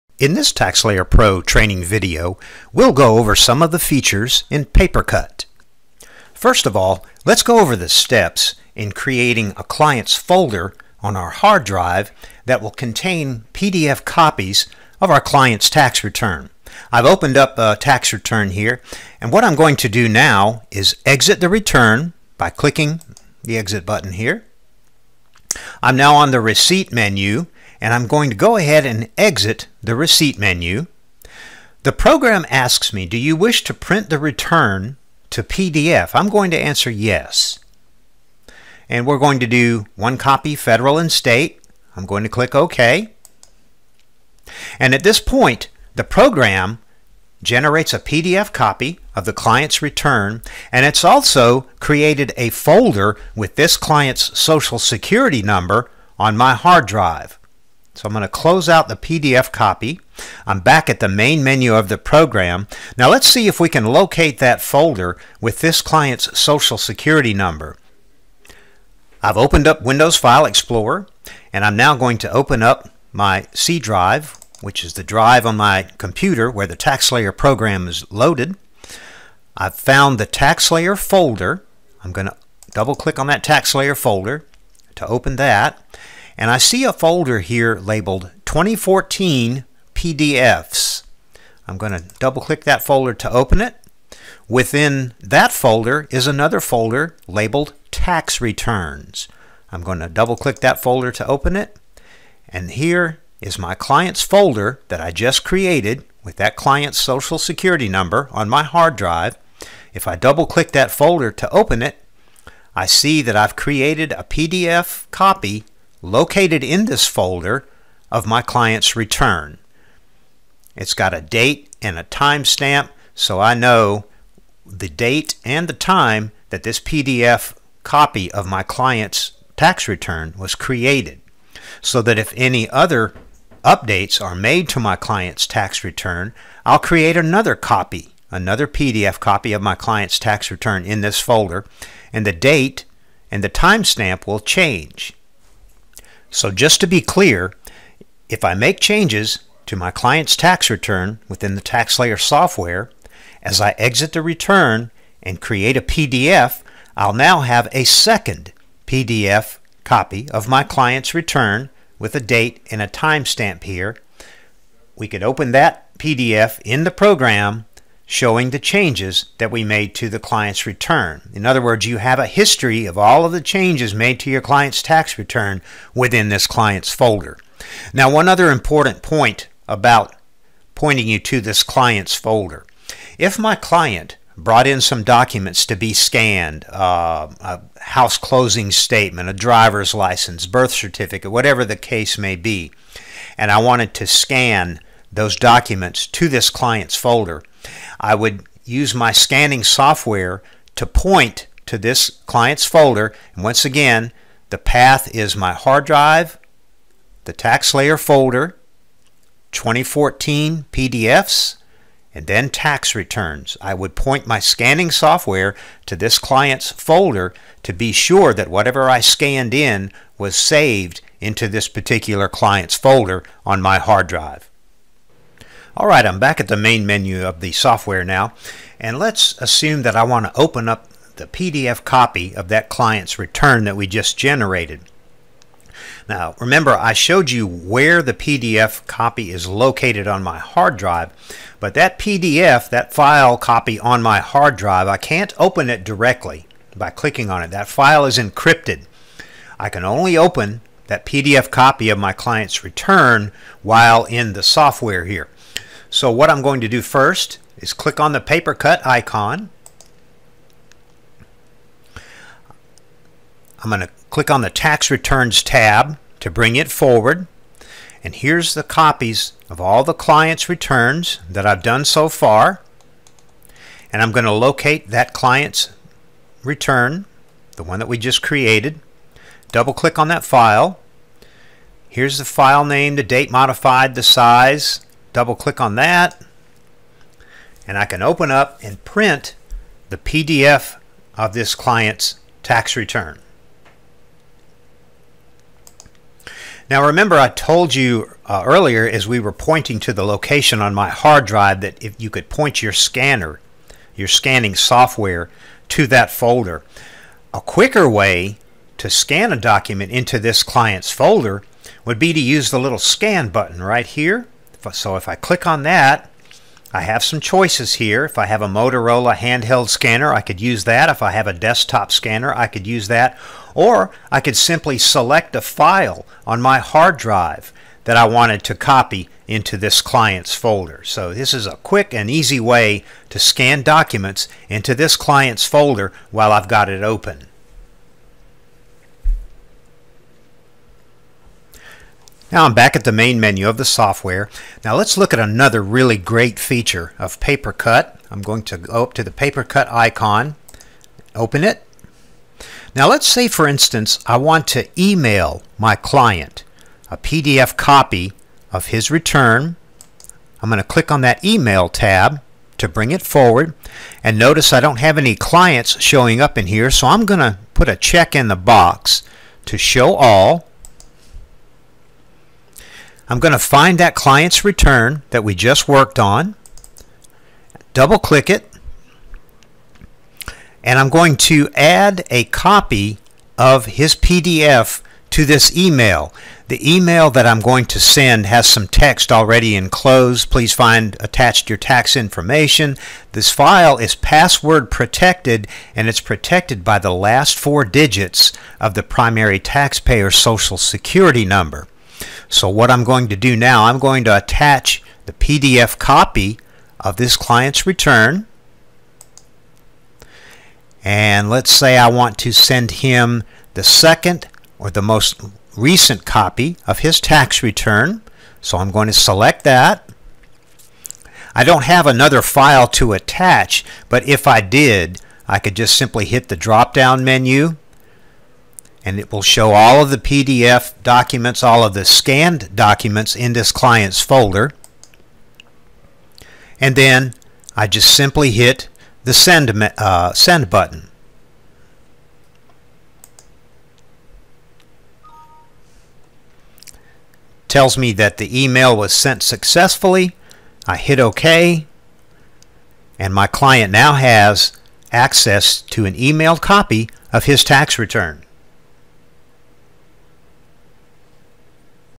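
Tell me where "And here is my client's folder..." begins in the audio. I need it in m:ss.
1:42.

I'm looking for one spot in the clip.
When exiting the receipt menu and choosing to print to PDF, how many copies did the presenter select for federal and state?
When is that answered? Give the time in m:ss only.
0:39.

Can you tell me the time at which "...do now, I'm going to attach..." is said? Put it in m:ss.
6:43.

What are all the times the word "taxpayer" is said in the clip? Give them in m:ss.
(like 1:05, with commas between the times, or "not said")
6:39.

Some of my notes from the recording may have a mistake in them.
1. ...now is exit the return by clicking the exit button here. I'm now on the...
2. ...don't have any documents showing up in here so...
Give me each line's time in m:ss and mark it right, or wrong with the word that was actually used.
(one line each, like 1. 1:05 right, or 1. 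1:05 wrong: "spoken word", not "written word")
1. 0:20 right
2. 6:04 wrong: "clients", not "documents".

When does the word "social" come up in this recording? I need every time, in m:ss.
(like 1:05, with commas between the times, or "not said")
0:54, 1:06, 1:46, 6:40.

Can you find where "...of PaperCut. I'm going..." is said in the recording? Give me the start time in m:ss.
5:46.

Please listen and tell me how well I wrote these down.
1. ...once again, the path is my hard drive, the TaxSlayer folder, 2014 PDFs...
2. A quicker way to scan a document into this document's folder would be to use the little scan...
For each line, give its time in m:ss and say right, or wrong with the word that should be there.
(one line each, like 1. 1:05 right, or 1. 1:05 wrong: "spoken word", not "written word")
1. 3:23 right
2. 5:07 wrong: "client", not "document".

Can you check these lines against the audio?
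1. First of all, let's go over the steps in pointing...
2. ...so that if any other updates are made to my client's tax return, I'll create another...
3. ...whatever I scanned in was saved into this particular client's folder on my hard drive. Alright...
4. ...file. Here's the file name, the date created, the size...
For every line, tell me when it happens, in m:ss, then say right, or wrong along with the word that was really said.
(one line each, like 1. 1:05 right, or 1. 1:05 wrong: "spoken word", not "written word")
1. 0:06 wrong: "creating", not "pointing"
2. 2:11 right
3. 3:38 right
4. 4:40 wrong: "modified", not "created".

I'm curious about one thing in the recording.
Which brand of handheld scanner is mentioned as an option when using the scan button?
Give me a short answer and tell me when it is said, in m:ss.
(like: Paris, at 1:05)
Motorola, at 5:18.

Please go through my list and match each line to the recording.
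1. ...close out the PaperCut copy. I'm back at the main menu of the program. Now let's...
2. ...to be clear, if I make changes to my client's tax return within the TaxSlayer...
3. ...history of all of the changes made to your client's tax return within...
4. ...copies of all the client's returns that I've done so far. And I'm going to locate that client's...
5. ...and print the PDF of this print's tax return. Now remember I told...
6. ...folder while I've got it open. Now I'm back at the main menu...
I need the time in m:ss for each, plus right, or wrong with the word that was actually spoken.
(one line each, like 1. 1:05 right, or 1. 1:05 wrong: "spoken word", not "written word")
1. 0:58 wrong: "PDF", not "PaperCut"
2. 2:26 right
3. 2:52 right
4. 4:28 right
5. 4:48 wrong: "client", not "print"
6. 5:35 right.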